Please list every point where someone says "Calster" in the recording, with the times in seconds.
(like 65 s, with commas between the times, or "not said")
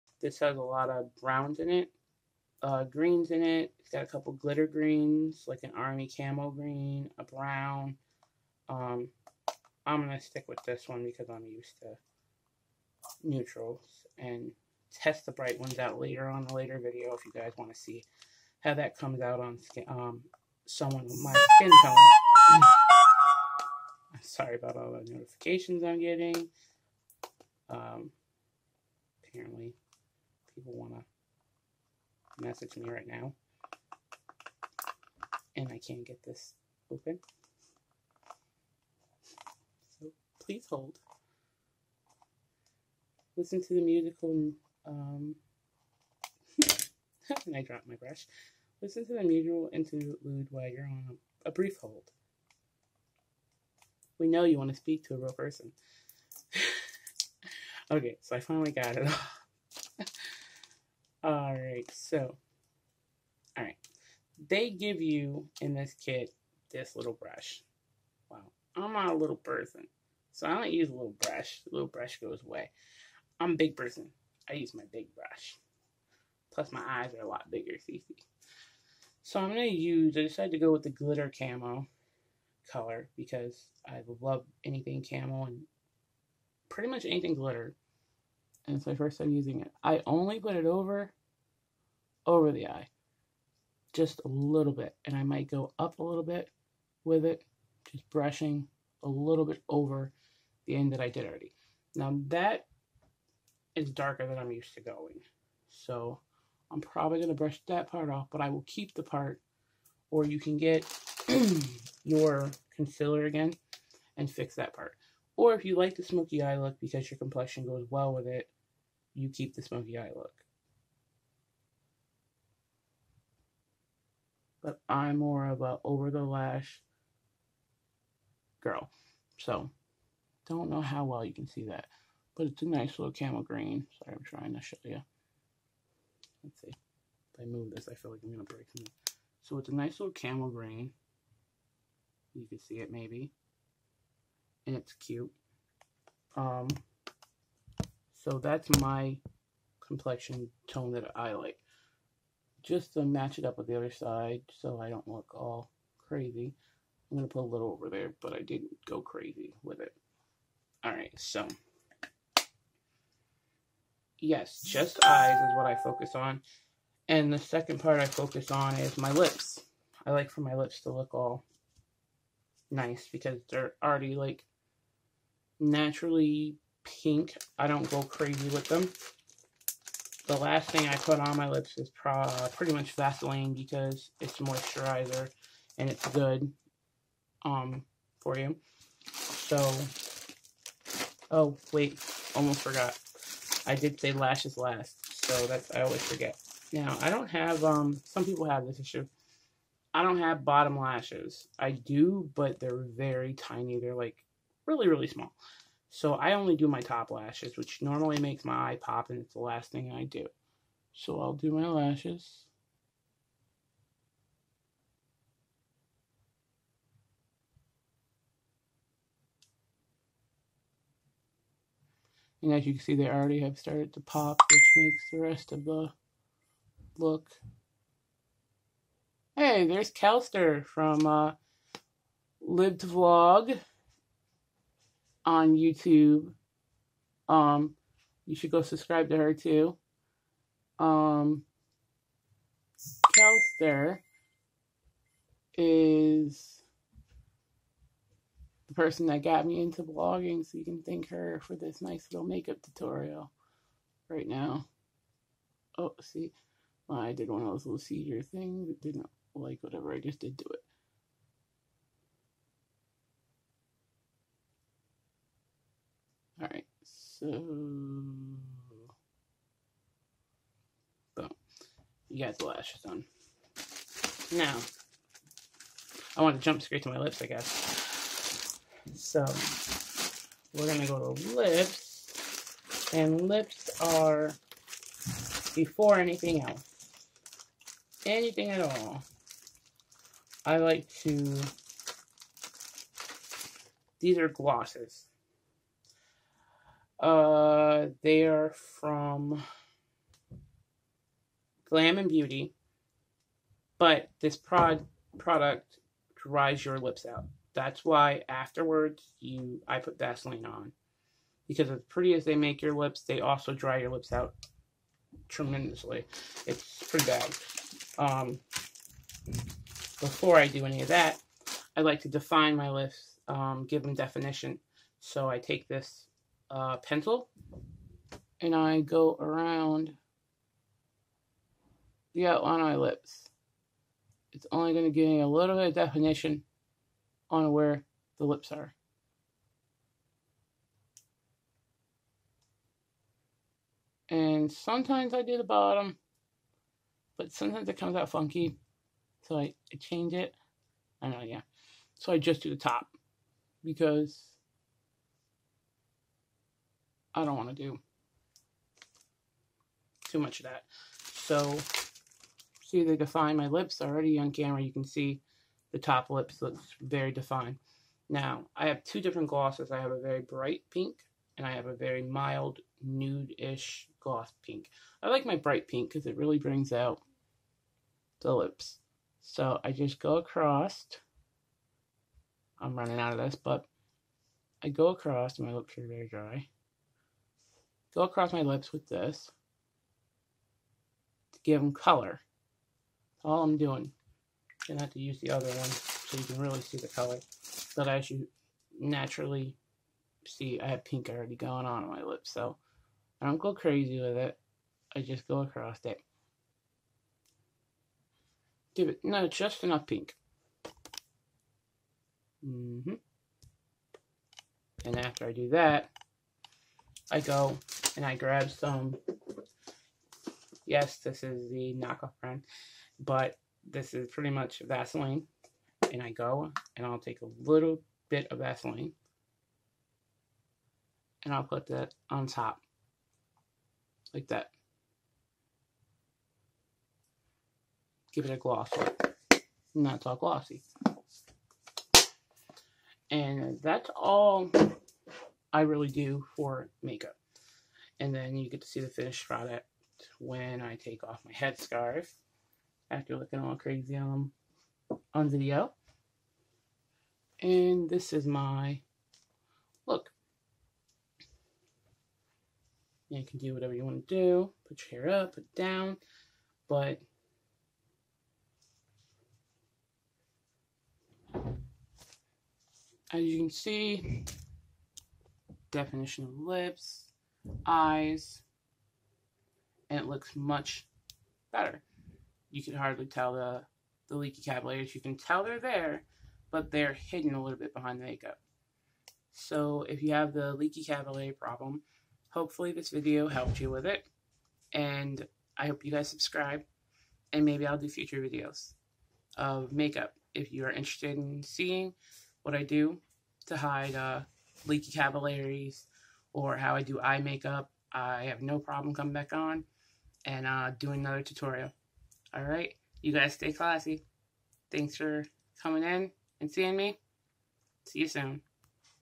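229 s.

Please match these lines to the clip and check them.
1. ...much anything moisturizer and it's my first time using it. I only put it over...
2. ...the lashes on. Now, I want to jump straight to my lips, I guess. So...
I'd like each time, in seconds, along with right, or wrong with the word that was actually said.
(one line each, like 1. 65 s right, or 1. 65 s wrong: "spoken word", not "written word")
1. 86 s wrong: "glitter", not "moisturizer"
2. 272 s right.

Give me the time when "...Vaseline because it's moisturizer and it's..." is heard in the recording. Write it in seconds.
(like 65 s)
182 s.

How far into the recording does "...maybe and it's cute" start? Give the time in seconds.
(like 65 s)
142 s.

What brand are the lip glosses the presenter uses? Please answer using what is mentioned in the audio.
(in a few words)
Glam and Beauty.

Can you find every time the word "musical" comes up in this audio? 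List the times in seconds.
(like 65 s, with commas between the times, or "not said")
43 s, 49 s.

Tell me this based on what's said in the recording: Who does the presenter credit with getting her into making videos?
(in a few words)
Kelster.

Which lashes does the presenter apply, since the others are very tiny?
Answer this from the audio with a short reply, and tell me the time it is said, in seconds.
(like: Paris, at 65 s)
Top lashes, at 206 s.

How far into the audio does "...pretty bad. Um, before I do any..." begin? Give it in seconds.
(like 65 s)
316 s.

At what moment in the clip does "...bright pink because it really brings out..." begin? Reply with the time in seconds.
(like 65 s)
375 s.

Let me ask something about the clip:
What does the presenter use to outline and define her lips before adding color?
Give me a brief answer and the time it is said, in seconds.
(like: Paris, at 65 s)
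Pencil, at 326 s.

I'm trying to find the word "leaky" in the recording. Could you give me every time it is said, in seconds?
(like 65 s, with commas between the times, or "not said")
484 s, 490 s, 504 s.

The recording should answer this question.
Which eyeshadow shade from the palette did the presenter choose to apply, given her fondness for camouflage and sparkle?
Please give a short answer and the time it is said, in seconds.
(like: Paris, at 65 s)
Glitter camo, at 80 s.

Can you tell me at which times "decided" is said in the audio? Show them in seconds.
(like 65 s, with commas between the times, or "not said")
80 s.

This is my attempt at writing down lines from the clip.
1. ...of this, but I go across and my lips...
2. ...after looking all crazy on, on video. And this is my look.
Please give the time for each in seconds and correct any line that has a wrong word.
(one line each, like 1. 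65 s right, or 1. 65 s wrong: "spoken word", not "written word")
1. 383 s right
2. 452 s right.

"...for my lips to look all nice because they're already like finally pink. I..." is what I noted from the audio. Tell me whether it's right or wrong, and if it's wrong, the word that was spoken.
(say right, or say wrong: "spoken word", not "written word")
wrong: "naturally", not "finally".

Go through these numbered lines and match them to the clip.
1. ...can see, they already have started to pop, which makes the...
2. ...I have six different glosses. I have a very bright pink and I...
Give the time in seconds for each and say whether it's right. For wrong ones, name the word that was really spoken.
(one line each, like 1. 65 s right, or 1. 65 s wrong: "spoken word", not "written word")
1. 222 s right
2. 368 s wrong: "two", not "six".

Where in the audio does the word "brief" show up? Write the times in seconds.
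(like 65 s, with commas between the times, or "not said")
51 s.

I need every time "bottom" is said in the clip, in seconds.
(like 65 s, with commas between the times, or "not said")
200 s, 345 s.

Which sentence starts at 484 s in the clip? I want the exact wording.
You can tell they're there, but they're hidden a little bit behind the makeup.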